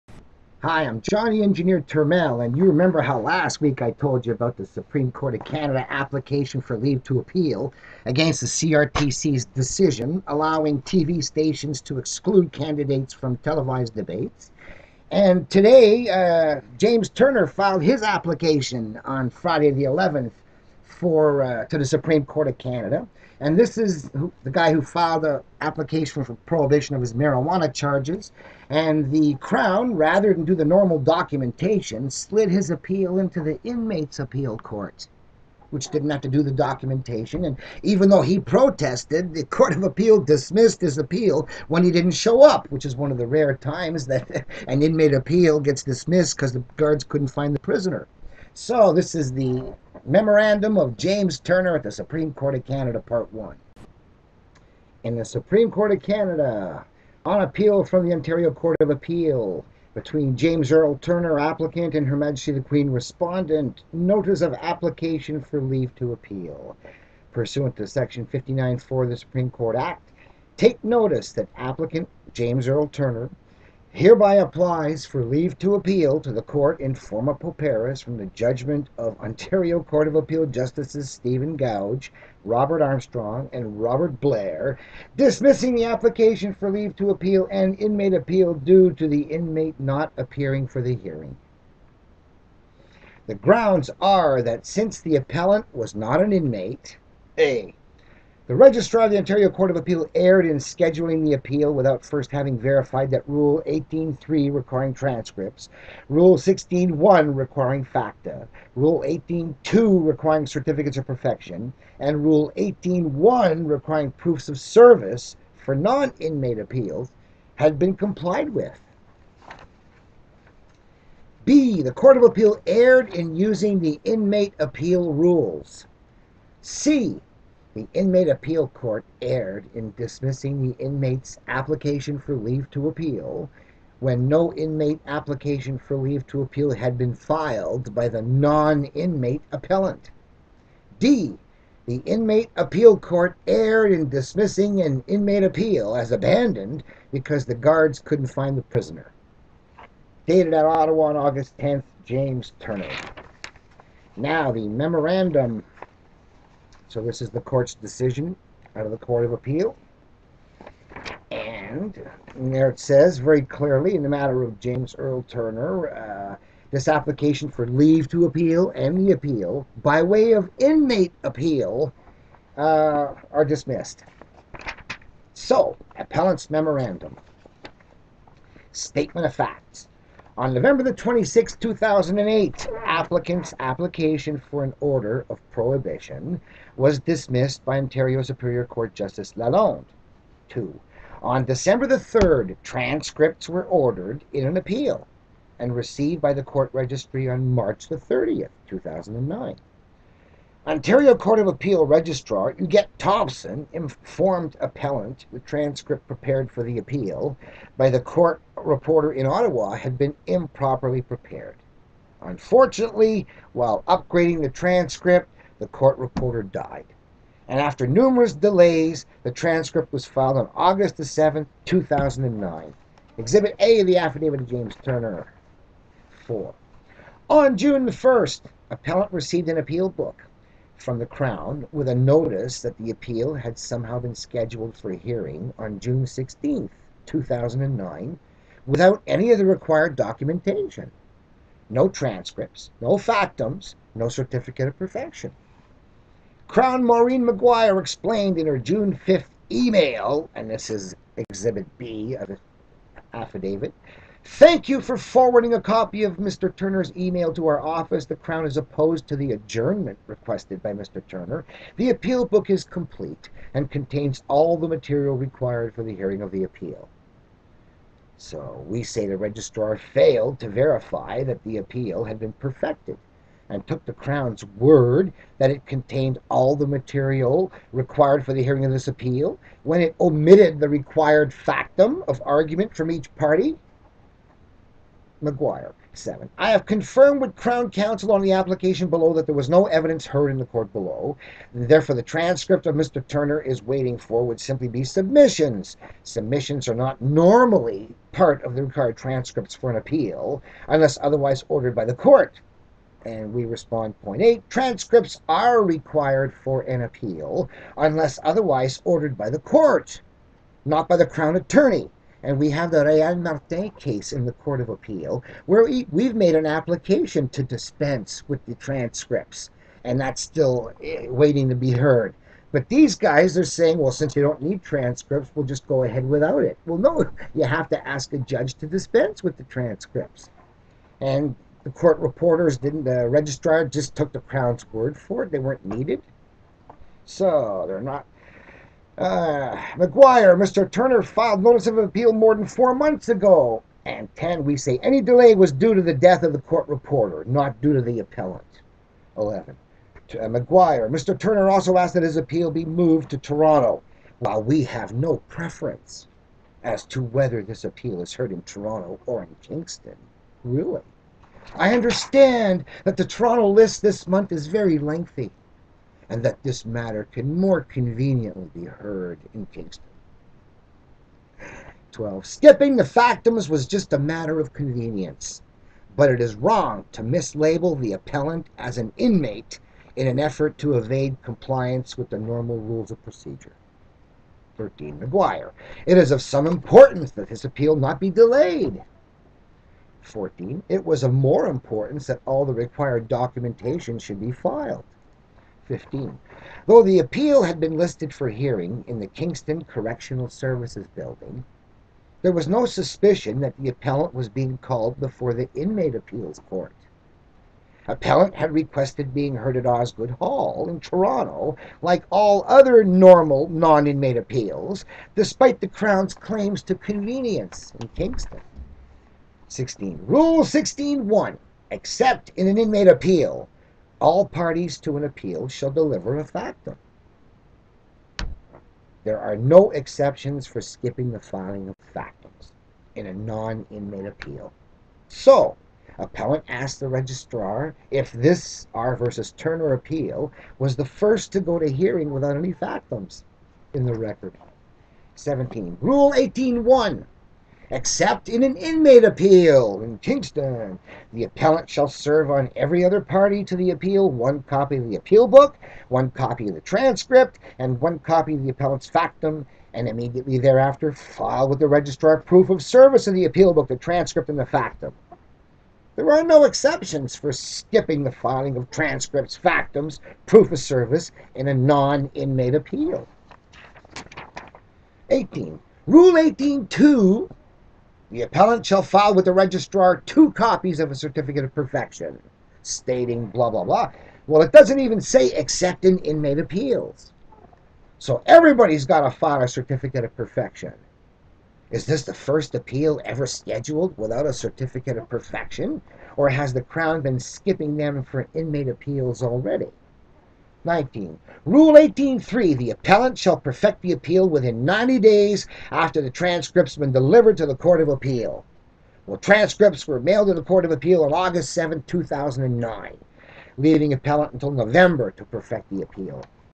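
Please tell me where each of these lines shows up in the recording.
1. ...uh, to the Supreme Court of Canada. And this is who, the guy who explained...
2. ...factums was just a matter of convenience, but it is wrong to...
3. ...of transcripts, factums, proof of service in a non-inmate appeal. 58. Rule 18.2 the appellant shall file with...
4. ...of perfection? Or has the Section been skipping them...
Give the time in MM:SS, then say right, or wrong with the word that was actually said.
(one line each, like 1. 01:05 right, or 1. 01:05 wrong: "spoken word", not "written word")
1. 00:21 wrong: "filed", not "explained"
2. 06:12 right
3. 07:48 wrong: "18", not "58"
4. 08:14 wrong: "Crown", not "Section".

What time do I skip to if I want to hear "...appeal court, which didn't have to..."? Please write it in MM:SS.
00:34.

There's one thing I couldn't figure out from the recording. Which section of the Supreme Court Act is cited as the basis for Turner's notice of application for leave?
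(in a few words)
59.4.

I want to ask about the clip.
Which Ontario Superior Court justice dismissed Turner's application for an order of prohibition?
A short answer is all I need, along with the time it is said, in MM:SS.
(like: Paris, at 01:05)
Lalonde, at 03:09.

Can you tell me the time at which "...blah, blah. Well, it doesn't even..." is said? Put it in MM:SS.
08:03.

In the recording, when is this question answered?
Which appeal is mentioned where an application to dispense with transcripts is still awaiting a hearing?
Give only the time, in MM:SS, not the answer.
05:12.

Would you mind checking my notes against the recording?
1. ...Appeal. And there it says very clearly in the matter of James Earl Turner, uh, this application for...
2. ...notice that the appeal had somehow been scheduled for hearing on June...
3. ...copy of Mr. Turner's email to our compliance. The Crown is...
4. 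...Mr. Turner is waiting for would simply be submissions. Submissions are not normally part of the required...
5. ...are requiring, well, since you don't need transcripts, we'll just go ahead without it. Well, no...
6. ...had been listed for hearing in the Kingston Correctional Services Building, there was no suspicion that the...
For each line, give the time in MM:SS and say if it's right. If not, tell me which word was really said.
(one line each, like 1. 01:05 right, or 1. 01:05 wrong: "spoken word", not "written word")
1. 02:39 right
2. 03:51 right
3. 04:15 wrong: "office", not "compliance"
4. 04:52 right
5. 05:23 wrong: "saying", not "requiring"
6. 06:37 right.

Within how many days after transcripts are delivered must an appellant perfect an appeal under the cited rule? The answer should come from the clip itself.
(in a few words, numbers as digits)
90.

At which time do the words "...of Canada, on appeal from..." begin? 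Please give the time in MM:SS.
00:55.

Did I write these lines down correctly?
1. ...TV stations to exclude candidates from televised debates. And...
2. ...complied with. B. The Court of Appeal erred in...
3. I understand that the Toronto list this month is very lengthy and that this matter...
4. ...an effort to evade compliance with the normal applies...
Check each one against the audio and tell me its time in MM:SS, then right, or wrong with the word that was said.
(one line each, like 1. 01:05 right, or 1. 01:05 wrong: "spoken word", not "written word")
1. 00:10 right
2. 01:57 right
3. 06:01 right
4. 06:20 wrong: "rules", not "applies".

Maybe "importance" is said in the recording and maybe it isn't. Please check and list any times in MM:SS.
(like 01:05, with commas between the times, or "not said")
06:26, 06:31.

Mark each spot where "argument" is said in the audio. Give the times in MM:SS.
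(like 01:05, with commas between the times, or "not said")
04:42.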